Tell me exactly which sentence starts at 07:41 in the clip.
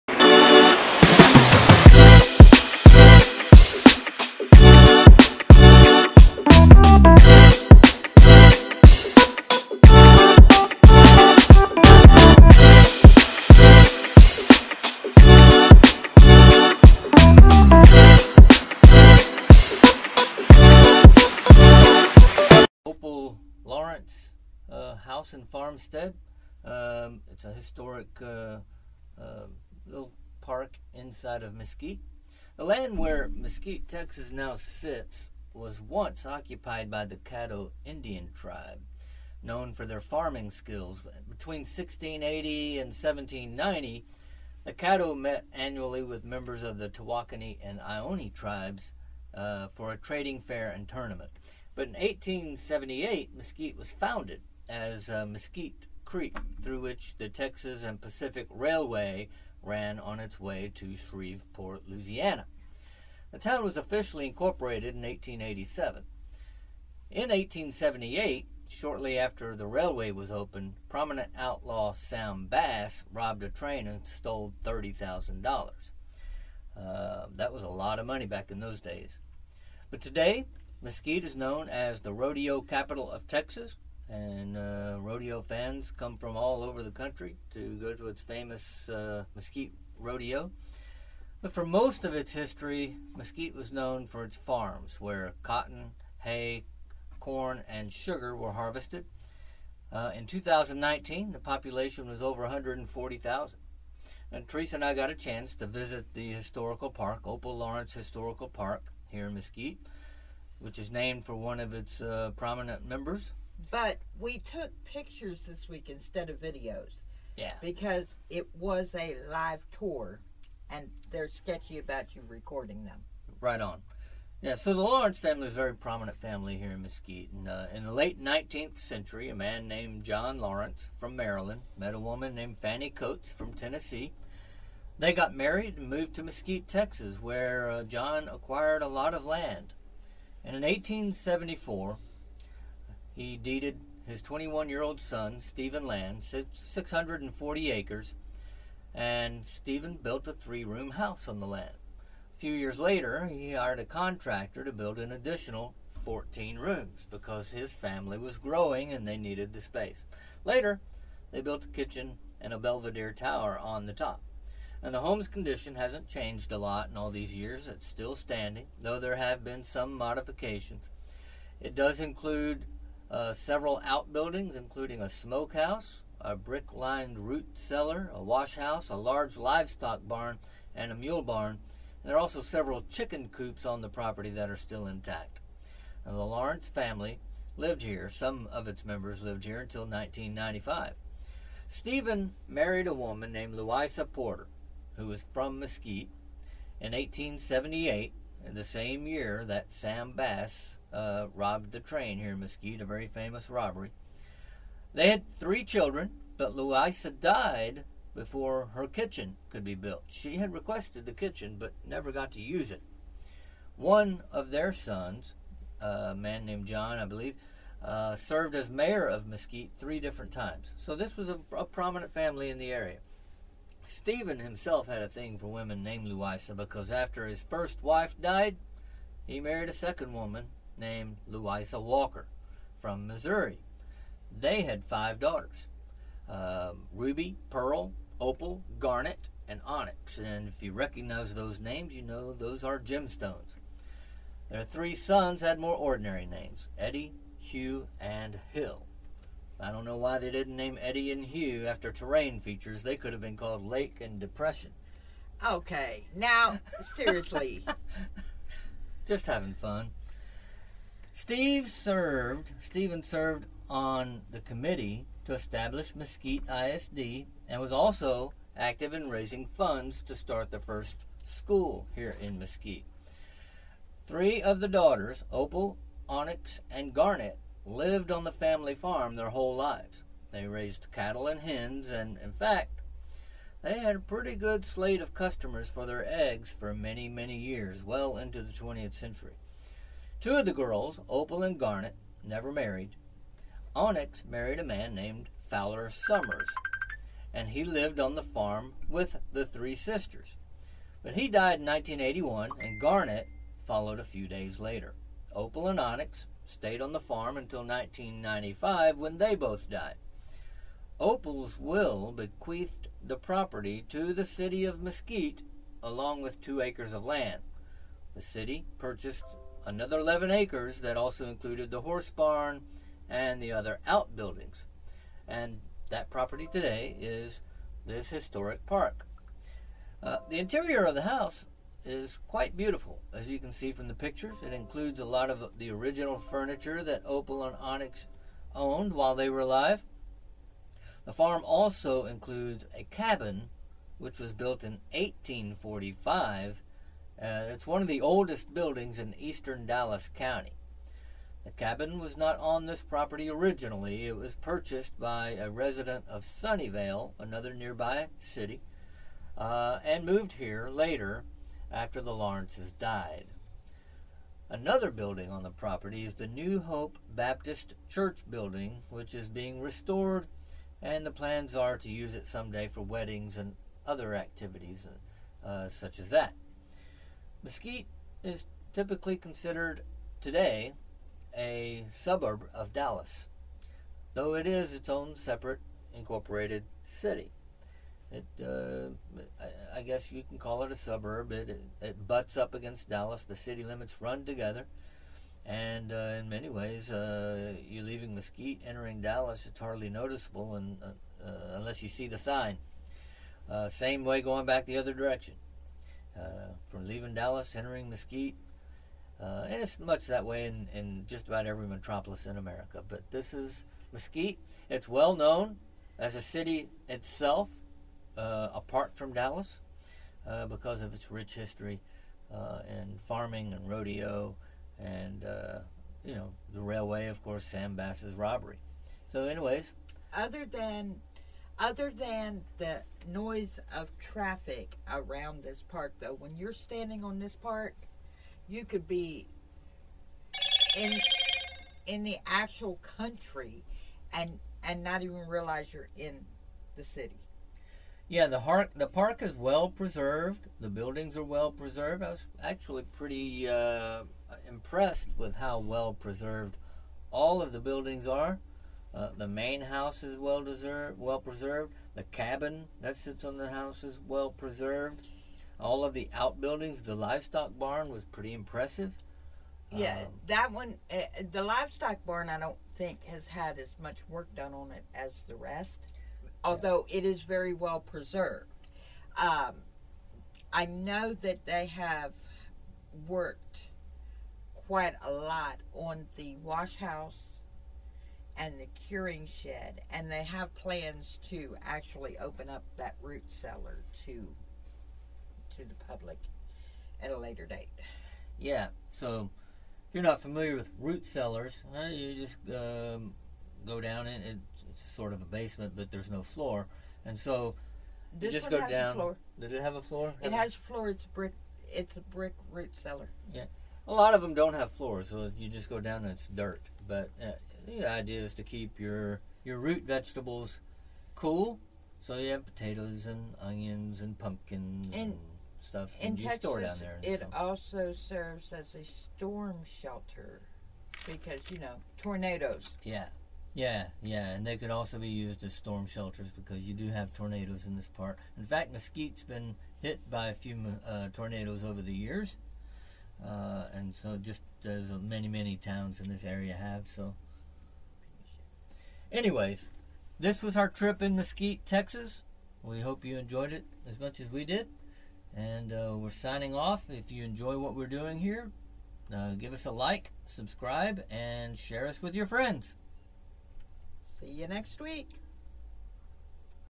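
The cabin that sits on the house is well preserved.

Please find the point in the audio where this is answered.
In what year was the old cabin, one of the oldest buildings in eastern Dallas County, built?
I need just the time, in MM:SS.
05:44.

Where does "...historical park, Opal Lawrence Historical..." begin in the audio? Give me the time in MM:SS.
01:46.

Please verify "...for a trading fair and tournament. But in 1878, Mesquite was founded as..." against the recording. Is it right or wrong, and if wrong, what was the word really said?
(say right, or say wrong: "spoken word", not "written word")
right.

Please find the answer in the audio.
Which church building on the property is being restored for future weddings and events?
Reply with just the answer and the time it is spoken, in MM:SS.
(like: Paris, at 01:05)
New Hope Baptist Church, at 06:06.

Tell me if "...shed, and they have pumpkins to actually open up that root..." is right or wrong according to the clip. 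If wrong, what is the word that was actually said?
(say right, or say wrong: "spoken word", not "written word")
wrong: "plans", not "pumpkins".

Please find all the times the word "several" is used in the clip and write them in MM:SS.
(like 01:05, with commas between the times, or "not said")
02:53, 03:02.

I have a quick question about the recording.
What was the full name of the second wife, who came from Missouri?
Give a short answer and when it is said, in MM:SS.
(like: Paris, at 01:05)
Louisa Walker, at 03:51.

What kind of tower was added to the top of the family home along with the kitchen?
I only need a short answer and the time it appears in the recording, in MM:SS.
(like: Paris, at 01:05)
Belvedere tower, at 02:42.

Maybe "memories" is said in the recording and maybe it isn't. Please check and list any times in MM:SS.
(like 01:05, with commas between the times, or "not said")
not said.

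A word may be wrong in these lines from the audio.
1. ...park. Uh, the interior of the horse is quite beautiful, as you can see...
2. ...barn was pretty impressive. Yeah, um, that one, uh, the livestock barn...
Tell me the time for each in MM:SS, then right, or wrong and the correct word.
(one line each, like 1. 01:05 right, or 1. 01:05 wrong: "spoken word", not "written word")
1. 05:28 wrong: "house", not "horse"
2. 07:47 right.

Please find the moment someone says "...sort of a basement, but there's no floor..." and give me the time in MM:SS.
08:24.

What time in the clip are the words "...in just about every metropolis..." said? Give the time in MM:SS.
06:50.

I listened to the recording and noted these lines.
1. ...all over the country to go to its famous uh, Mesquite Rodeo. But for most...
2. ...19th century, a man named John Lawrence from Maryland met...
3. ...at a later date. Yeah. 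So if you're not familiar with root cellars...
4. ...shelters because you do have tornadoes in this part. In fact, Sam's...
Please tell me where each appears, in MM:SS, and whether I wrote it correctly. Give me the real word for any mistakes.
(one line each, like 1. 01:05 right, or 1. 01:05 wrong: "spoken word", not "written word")
1. 01:26 right
2. 02:08 right
3. 08:17 right
4. 08:55 wrong: "Mesquite", not "Sam".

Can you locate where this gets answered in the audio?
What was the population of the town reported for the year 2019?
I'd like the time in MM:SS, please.
01:42.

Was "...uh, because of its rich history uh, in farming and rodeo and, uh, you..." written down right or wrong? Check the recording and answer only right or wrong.
right.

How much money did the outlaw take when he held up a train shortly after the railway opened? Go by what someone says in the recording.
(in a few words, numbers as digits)
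$30,000.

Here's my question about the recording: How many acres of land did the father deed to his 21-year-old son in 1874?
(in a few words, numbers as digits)
640.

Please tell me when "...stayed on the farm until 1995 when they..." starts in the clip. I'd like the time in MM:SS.
05:06.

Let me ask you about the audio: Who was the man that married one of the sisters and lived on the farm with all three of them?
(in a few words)
Fowler Summers.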